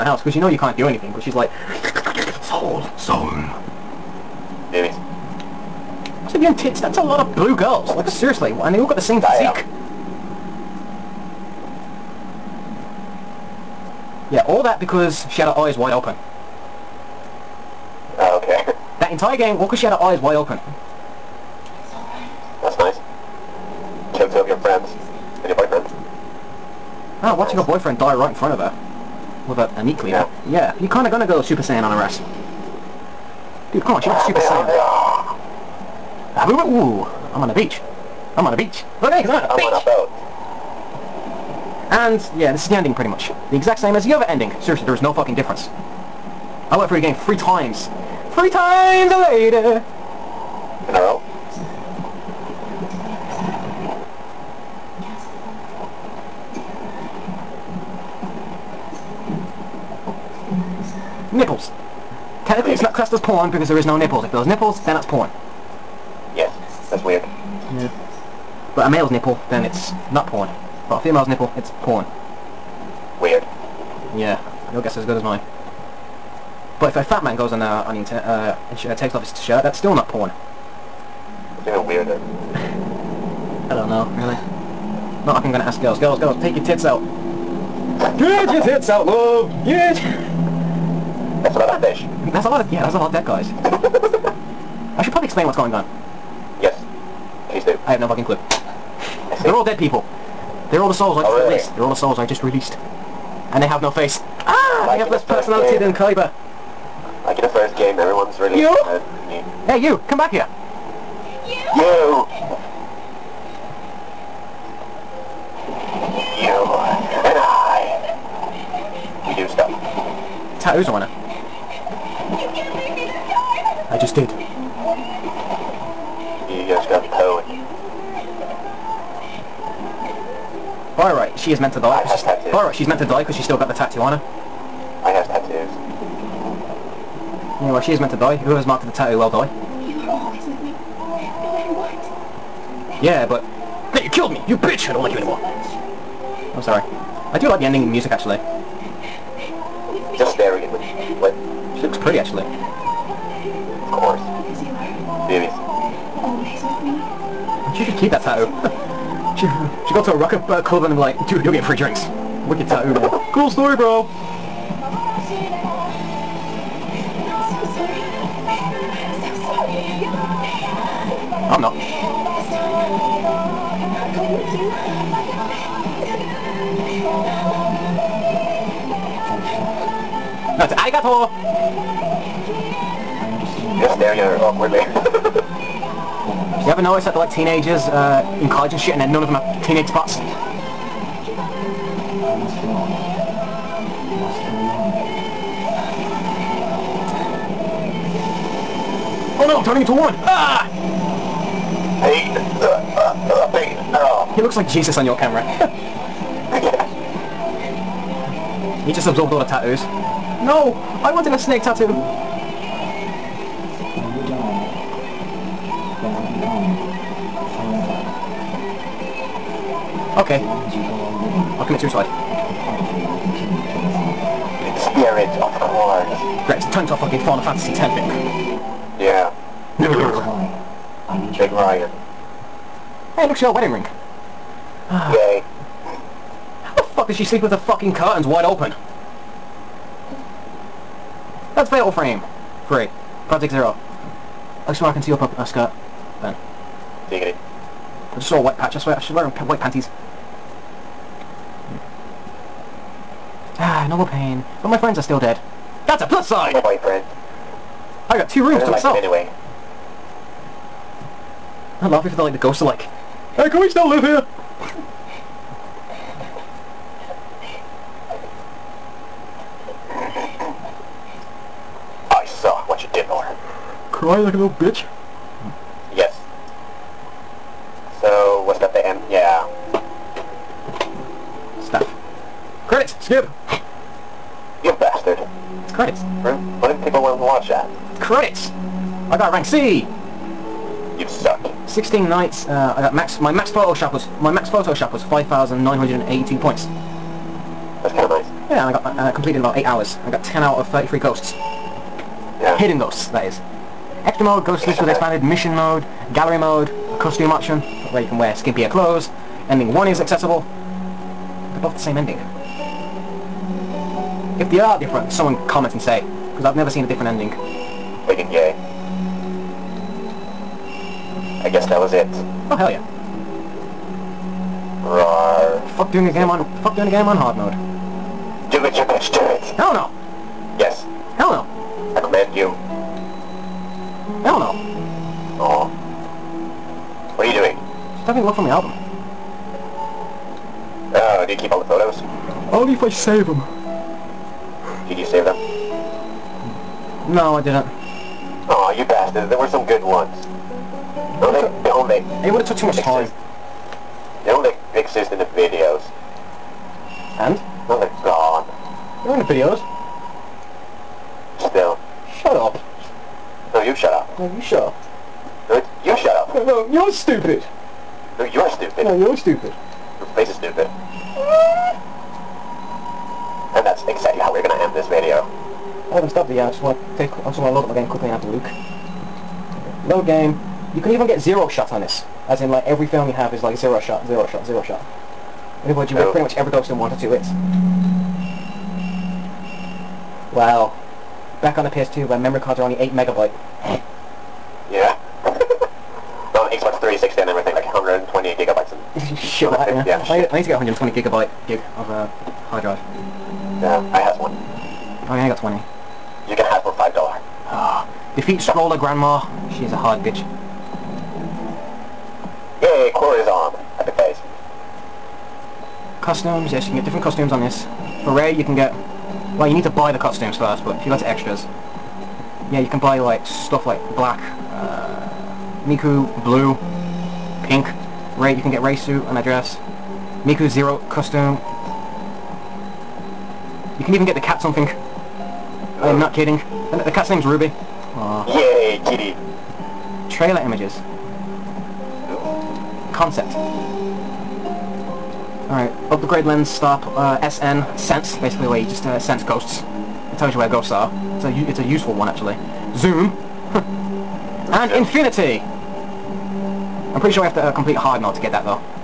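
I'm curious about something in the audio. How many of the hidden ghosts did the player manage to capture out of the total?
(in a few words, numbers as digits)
10 out of 33.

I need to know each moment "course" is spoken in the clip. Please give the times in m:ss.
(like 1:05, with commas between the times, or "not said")
2:33, 3:45.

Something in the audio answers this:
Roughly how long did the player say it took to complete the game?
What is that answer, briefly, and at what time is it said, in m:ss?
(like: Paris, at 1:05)
8 hours, at 4:59.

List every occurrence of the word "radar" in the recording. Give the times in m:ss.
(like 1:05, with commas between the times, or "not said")
not said.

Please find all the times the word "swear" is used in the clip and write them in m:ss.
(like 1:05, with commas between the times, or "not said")
4:04, 4:08.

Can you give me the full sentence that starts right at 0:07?
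Like, seriously, and they all got the same Damn.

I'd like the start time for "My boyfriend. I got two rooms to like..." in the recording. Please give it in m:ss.
4:16.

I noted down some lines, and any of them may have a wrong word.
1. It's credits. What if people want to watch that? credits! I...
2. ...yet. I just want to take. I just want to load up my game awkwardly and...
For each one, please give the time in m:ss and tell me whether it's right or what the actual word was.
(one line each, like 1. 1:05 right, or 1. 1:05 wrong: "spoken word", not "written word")
1. 4:45 right
2. 6:16 wrong: "quickly", not "awkwardly".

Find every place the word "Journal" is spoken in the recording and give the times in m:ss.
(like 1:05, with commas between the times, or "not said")
not said.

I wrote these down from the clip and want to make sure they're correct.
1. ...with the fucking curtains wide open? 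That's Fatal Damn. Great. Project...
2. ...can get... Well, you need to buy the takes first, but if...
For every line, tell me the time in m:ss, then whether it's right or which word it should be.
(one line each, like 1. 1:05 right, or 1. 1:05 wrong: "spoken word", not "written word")
1. 3:57 wrong: "Frame", not "Damn"
2. 6:58 wrong: "costumes", not "takes".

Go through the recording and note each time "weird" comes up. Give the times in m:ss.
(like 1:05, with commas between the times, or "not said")
1:07, 1:13, 1:21.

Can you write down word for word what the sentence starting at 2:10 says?
Alright, she is meant to die.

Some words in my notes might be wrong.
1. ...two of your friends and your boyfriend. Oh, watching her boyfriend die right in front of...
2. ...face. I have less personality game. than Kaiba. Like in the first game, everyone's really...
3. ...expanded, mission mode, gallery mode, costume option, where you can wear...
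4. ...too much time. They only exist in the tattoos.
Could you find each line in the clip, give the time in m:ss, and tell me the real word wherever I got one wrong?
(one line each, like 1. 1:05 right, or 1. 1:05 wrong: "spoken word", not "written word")
1. 0:24 right
2. 1:43 right
3. 5:04 right
4. 5:52 wrong: "videos", not "tattoos".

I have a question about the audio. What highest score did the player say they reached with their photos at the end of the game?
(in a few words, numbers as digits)
5,982 points.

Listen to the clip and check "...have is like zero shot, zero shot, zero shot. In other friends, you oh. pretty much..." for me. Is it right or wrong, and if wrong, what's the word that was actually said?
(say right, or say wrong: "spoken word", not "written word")
wrong: "words", not "friends".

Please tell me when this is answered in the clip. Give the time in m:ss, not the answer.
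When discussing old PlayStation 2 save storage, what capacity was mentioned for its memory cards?
6:32.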